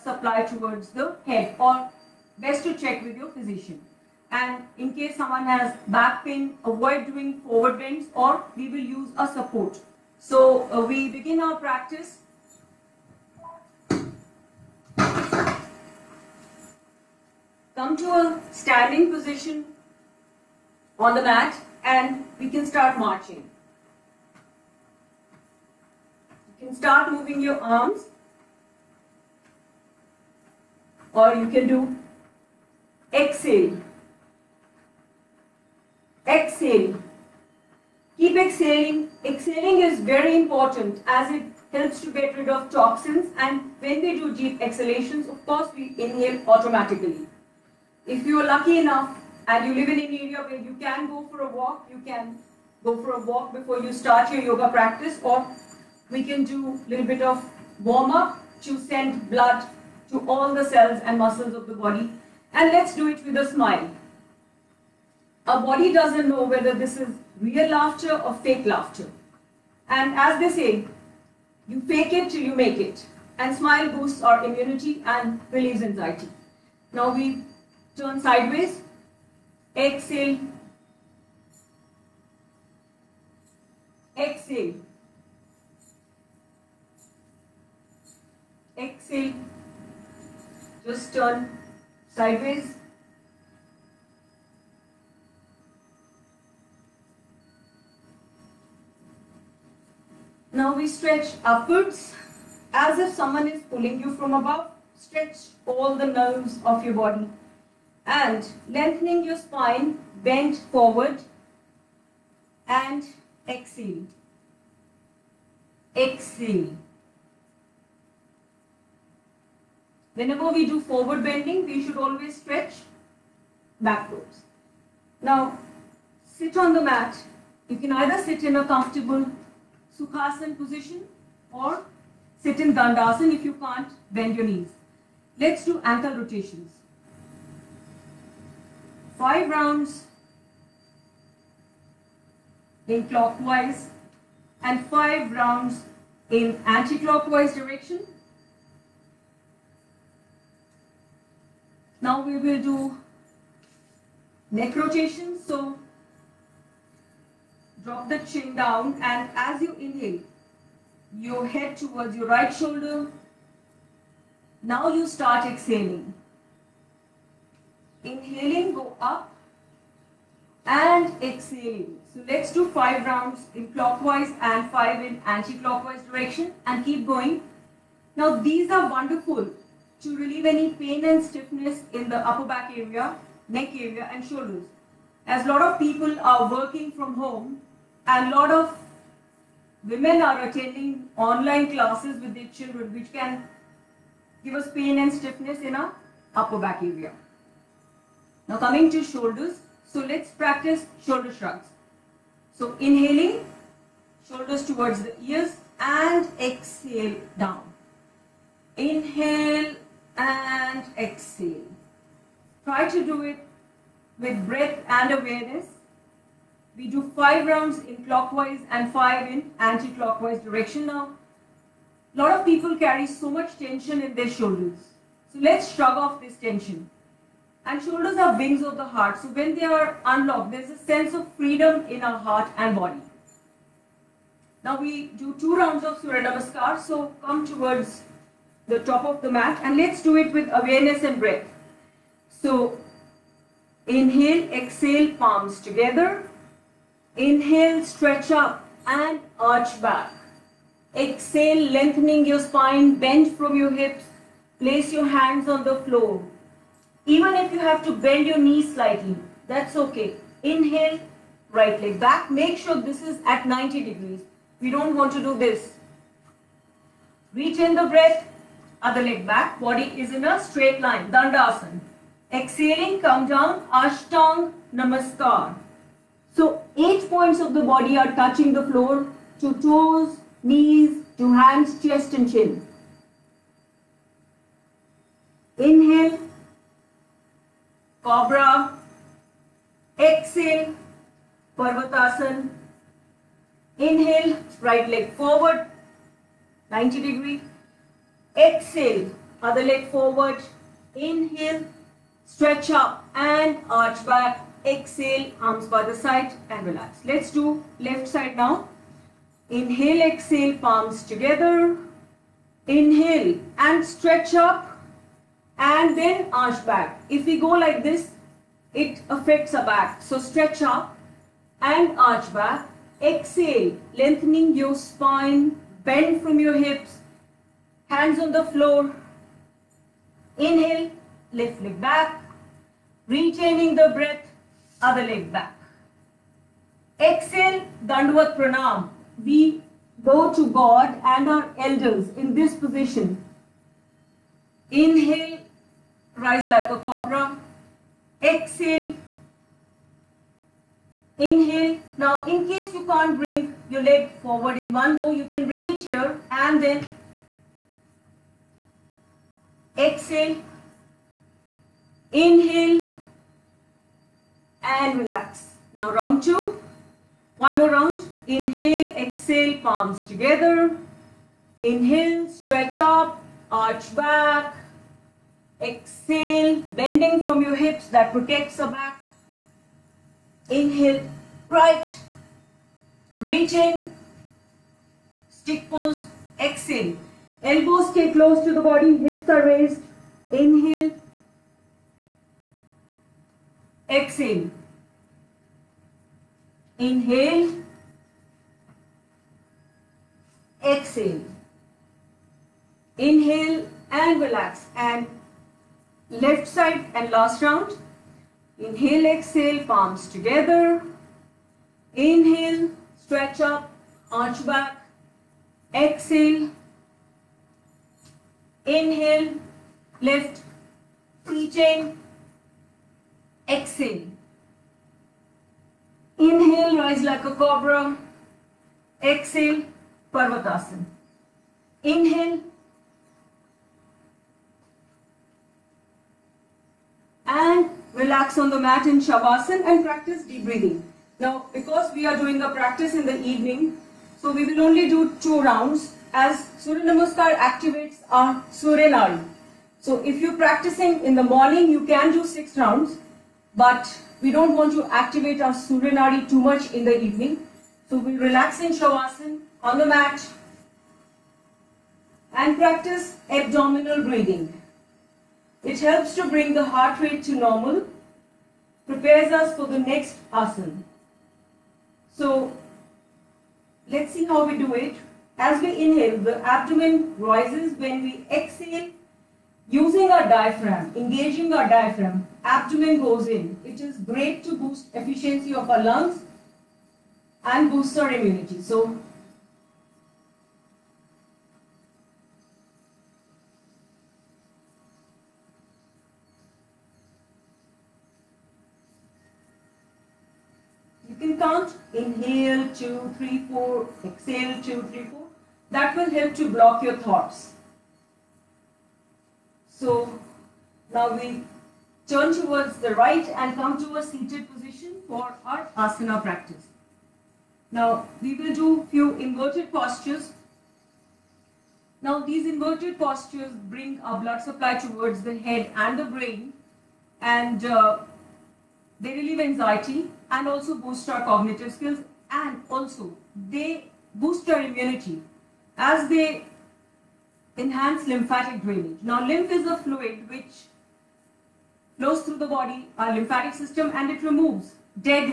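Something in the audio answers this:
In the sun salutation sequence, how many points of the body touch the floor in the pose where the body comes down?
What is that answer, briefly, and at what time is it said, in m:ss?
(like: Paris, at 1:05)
8, at 4:36.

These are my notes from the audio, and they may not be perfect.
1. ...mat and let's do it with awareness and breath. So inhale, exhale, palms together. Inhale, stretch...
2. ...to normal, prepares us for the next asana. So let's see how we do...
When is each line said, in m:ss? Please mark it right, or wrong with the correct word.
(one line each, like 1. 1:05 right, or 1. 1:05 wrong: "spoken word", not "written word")
1. 3:59 right
2. 7:47 right.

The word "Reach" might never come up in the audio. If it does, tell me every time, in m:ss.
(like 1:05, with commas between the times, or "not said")
4:27, 6:23.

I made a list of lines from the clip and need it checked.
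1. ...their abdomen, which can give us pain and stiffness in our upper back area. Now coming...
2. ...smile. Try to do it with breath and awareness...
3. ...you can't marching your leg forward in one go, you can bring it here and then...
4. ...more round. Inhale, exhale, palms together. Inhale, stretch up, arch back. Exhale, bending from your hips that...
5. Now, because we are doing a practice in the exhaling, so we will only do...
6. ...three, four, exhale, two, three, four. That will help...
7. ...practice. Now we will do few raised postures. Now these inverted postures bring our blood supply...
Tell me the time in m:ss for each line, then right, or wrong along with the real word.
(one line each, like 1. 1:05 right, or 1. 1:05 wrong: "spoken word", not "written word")
1. 3:12 wrong: "children", not "abdomen"
2. 3:30 wrong: "exhale", not "smile"
3. 5:52 wrong: "bring", not "marching"
4. 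6:07 right
5. 7:21 wrong: "evening", not "exhaling"
6. 8:23 right
7. 8:36 wrong: "inverted", not "raised".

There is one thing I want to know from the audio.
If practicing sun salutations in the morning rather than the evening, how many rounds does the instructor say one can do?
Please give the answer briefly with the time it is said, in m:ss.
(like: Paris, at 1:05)
6, at 7:32.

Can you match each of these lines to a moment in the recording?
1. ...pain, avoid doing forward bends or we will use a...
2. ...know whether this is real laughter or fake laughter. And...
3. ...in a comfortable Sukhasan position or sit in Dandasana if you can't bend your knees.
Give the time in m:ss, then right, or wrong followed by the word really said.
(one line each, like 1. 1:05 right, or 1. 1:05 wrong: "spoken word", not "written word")
1. 0:06 right
2. 1:06 right
3. 2:08 right.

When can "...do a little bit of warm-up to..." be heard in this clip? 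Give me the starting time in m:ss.
0:56.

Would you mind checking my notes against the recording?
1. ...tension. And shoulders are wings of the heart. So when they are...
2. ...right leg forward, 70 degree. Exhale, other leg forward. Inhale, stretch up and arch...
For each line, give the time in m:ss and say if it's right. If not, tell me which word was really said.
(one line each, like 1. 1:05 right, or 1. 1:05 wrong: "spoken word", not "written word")
1. 3:46 right
2. 4:54 wrong: "90", not "70".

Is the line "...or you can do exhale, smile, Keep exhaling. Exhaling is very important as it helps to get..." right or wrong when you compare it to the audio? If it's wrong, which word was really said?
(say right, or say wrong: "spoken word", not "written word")
wrong: "exhale", not "smile".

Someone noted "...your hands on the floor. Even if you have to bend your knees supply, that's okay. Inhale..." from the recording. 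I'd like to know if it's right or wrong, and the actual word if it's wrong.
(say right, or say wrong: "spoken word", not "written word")
wrong: "slightly", not "supply".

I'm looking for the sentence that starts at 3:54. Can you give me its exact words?
Now we do two rounds of Surya Namaskar.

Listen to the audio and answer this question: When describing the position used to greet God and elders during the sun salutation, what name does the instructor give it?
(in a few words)
Dandvat Pranam.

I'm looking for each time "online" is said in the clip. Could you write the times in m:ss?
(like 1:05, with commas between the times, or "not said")
3:11.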